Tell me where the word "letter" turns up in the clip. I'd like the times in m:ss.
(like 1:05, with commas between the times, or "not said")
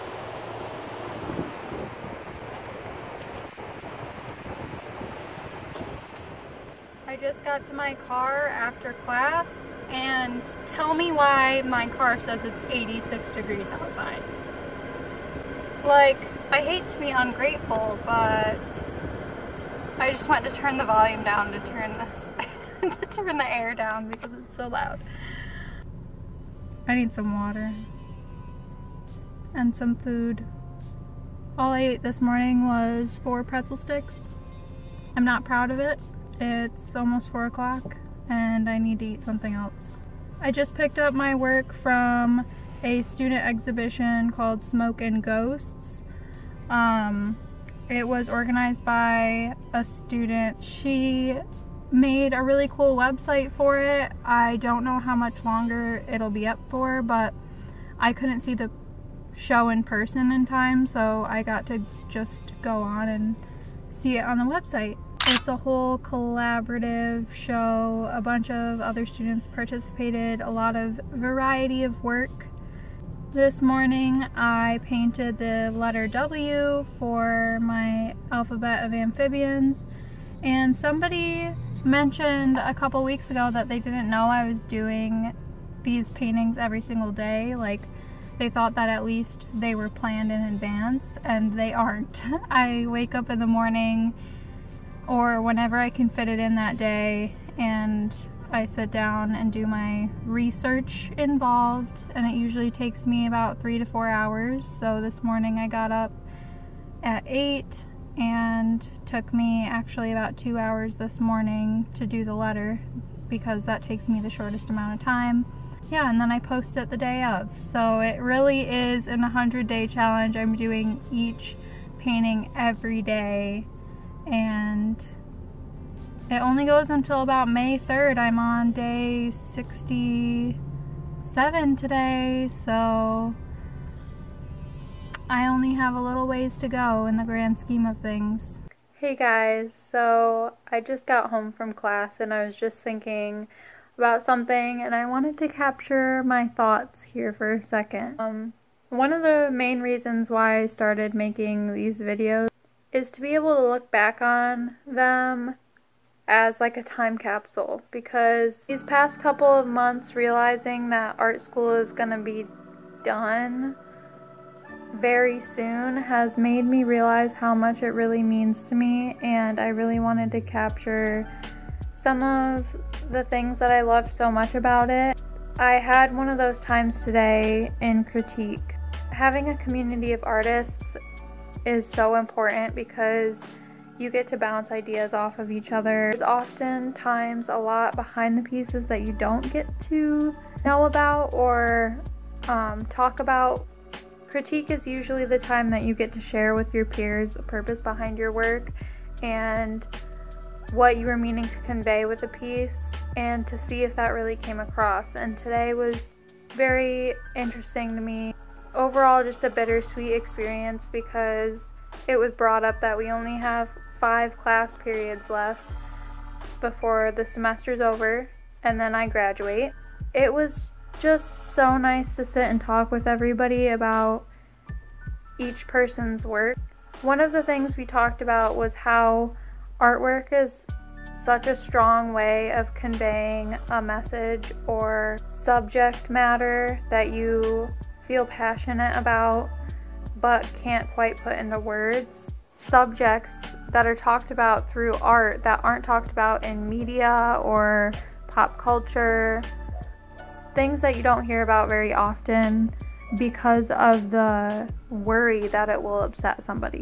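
1:15, 1:52.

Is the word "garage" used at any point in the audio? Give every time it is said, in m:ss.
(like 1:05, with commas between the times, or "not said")
not said.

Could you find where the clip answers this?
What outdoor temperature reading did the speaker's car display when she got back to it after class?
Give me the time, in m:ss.
0:12.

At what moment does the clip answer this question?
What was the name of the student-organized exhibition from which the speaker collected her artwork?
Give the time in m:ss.
0:44.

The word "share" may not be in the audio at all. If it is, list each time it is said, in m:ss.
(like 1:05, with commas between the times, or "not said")
3:16.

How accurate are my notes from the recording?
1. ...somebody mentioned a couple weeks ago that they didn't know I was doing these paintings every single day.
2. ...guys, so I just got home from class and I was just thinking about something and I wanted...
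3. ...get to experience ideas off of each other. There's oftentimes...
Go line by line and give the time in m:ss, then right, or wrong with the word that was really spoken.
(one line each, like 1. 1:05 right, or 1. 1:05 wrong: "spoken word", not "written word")
1. 1:20 right
2. 2:19 right
3. 3:04 wrong: "bounce", not "experience".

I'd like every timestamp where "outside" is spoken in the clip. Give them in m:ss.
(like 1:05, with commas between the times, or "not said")
0:13.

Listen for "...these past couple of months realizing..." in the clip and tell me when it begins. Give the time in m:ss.
2:38.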